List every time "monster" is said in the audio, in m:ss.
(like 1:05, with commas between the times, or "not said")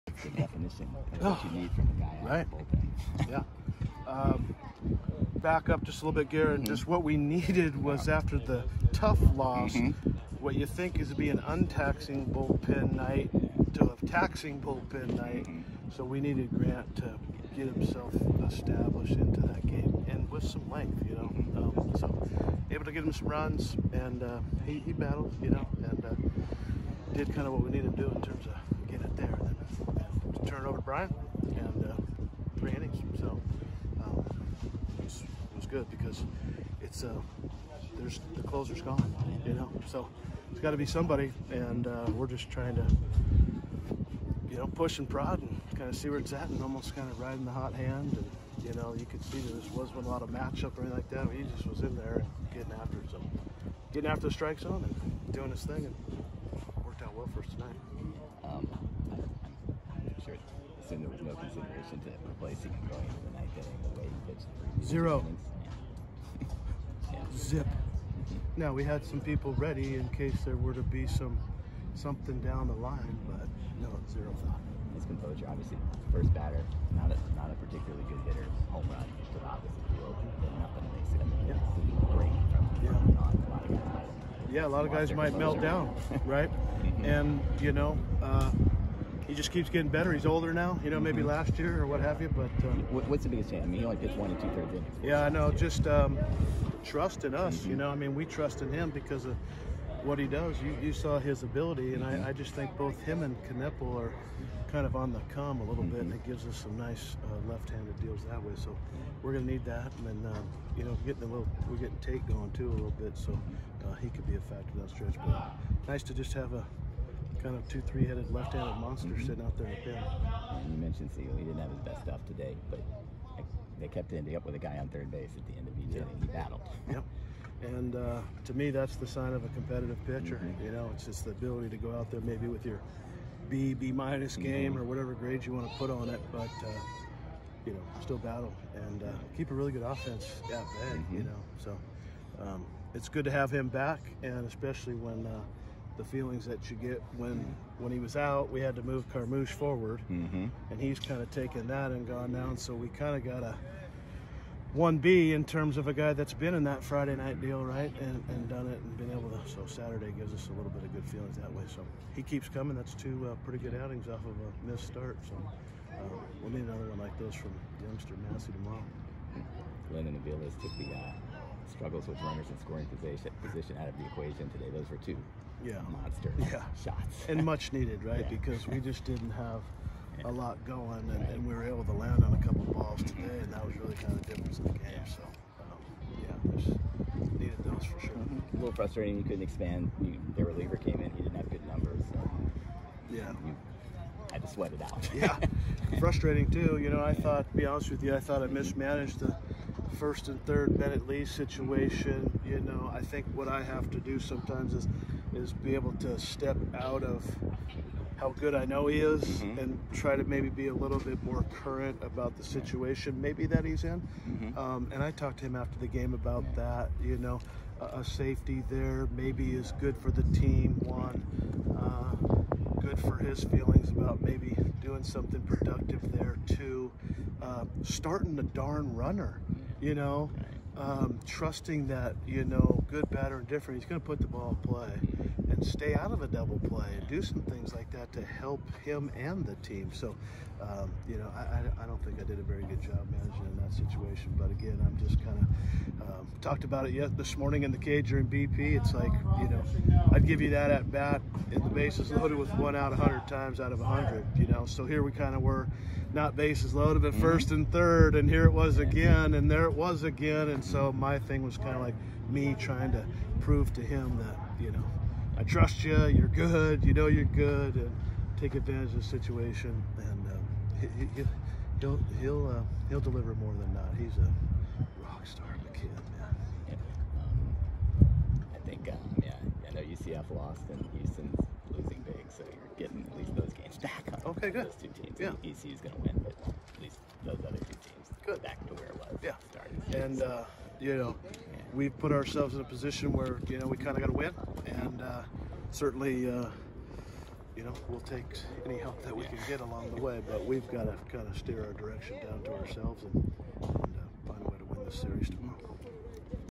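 1:58, 2:55.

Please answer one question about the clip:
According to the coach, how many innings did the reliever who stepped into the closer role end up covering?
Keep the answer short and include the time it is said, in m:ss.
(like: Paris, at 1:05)
3, at 0:32.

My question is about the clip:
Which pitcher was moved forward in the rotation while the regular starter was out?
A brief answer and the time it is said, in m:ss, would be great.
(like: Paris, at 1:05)
Carmouche, at 2:29.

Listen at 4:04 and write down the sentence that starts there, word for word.
But again, I'm just kind of um, talked about it yet this morning in the cage during BP.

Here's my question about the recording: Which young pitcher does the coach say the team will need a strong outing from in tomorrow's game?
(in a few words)
Massey.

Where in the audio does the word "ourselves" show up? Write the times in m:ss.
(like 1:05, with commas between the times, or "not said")
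4:52, 5:02.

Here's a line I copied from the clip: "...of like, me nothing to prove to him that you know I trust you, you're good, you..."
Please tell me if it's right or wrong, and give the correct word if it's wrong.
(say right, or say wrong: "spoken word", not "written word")
wrong: "trying", not "nothing".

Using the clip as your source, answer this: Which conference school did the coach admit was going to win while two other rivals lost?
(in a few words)
ECU.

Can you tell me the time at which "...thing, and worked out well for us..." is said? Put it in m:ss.
0:55.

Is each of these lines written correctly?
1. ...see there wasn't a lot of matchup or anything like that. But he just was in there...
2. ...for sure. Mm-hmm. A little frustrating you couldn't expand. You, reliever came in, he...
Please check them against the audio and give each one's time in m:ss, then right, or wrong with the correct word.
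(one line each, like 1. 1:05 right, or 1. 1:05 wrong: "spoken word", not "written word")
1. 0:49 right
2. 3:07 right.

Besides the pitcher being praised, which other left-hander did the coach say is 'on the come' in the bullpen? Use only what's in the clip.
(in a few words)
Knippel.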